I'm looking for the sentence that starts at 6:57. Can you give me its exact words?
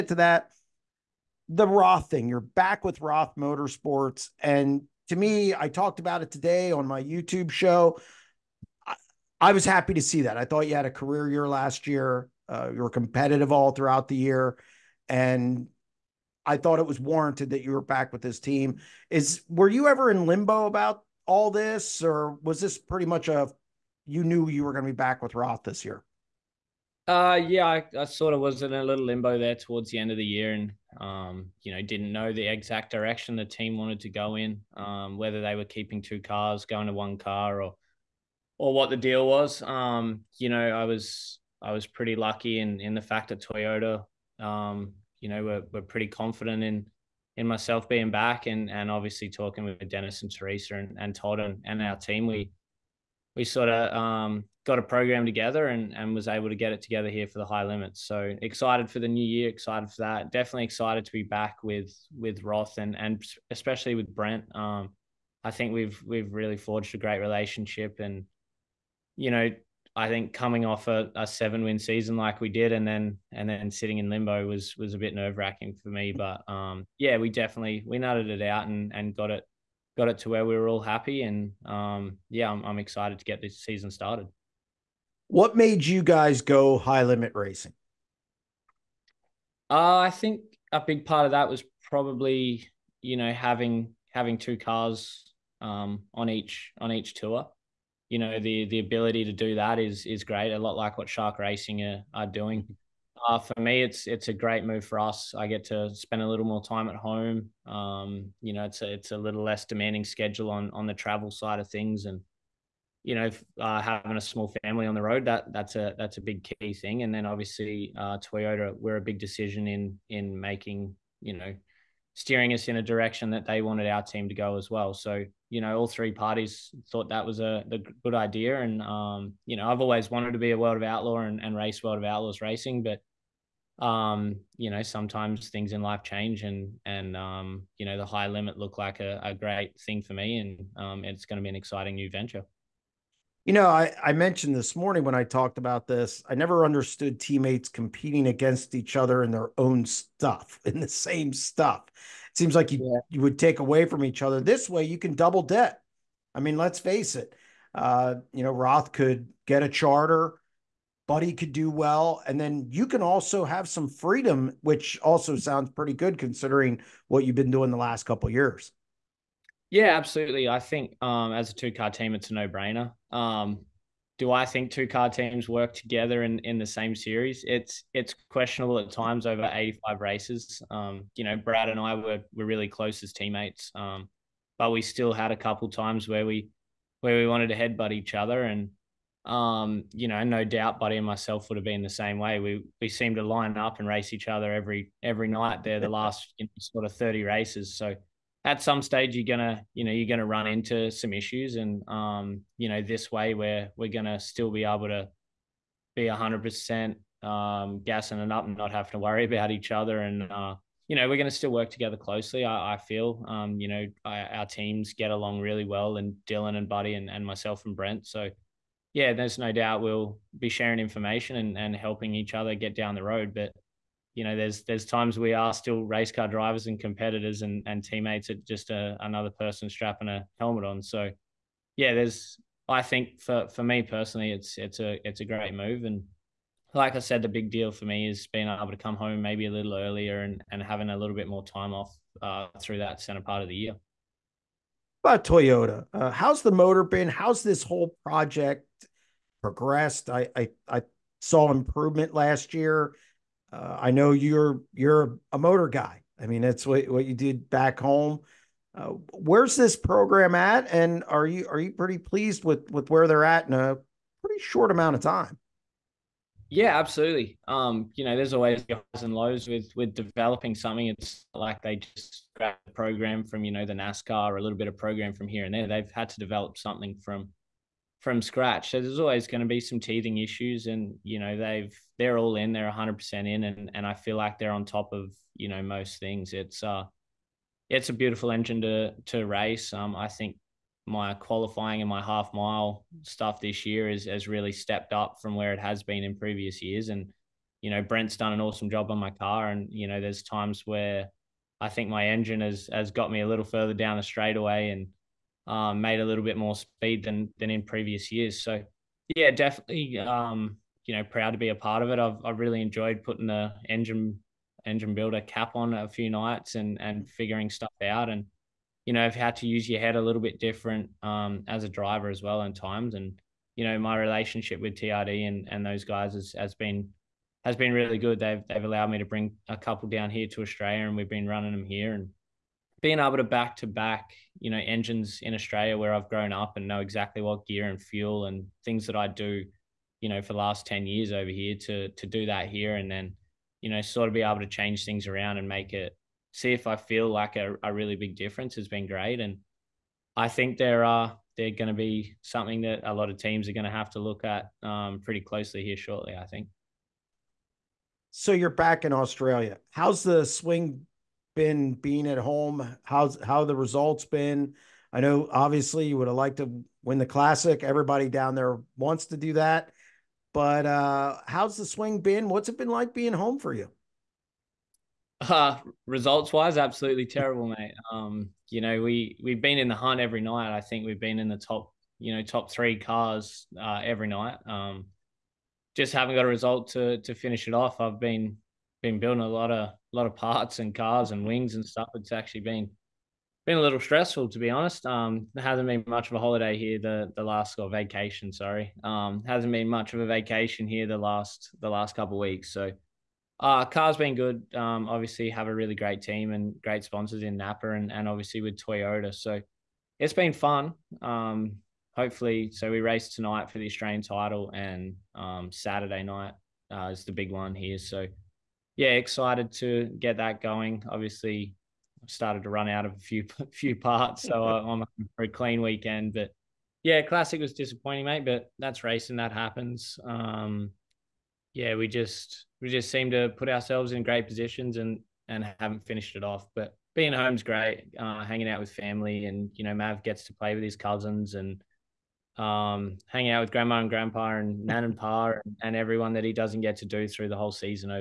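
So yeah, excited to get that going.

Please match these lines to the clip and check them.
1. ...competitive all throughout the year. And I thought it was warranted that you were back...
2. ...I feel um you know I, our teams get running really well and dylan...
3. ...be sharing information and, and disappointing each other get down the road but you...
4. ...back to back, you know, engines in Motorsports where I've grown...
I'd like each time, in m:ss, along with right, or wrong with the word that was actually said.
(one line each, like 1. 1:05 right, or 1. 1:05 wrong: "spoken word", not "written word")
1. 0:12 right
2. 3:32 wrong: "along", not "running"
3. 3:40 wrong: "helping", not "disappointing"
4. 5:33 wrong: "Australia", not "Motorsports".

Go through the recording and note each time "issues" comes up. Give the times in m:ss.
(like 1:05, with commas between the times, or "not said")
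3:21, 4:40.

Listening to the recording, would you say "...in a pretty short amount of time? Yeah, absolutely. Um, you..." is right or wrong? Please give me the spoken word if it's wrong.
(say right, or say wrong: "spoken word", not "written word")
right.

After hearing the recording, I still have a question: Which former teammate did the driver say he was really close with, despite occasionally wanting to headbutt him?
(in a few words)
Brad.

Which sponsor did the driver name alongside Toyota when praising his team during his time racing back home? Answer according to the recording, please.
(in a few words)
Napa.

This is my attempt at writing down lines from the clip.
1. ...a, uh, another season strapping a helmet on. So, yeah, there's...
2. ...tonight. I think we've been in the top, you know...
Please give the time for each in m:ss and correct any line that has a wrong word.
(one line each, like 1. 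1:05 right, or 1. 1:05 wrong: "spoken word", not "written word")
1. 3:48 wrong: "person", not "season"
2. 6:20 wrong: "night", not "tonight".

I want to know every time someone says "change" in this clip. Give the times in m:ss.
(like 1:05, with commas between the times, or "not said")
2:16, 5:44.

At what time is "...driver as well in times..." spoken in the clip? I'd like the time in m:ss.
5:21.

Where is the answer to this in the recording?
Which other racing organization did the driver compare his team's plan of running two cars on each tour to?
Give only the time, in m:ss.
1:41.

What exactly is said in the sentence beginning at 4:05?
About Toyota, uh, how's the motor been?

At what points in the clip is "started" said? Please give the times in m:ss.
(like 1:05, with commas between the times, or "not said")
1:23, 7:02.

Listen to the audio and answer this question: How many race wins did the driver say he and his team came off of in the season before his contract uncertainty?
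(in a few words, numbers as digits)
7.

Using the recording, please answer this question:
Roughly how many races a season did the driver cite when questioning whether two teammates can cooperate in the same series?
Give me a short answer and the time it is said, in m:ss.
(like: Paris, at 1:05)
85, at 2:59.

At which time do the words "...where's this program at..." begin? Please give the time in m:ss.
4:19.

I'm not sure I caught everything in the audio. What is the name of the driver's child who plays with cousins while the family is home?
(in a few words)
Mav.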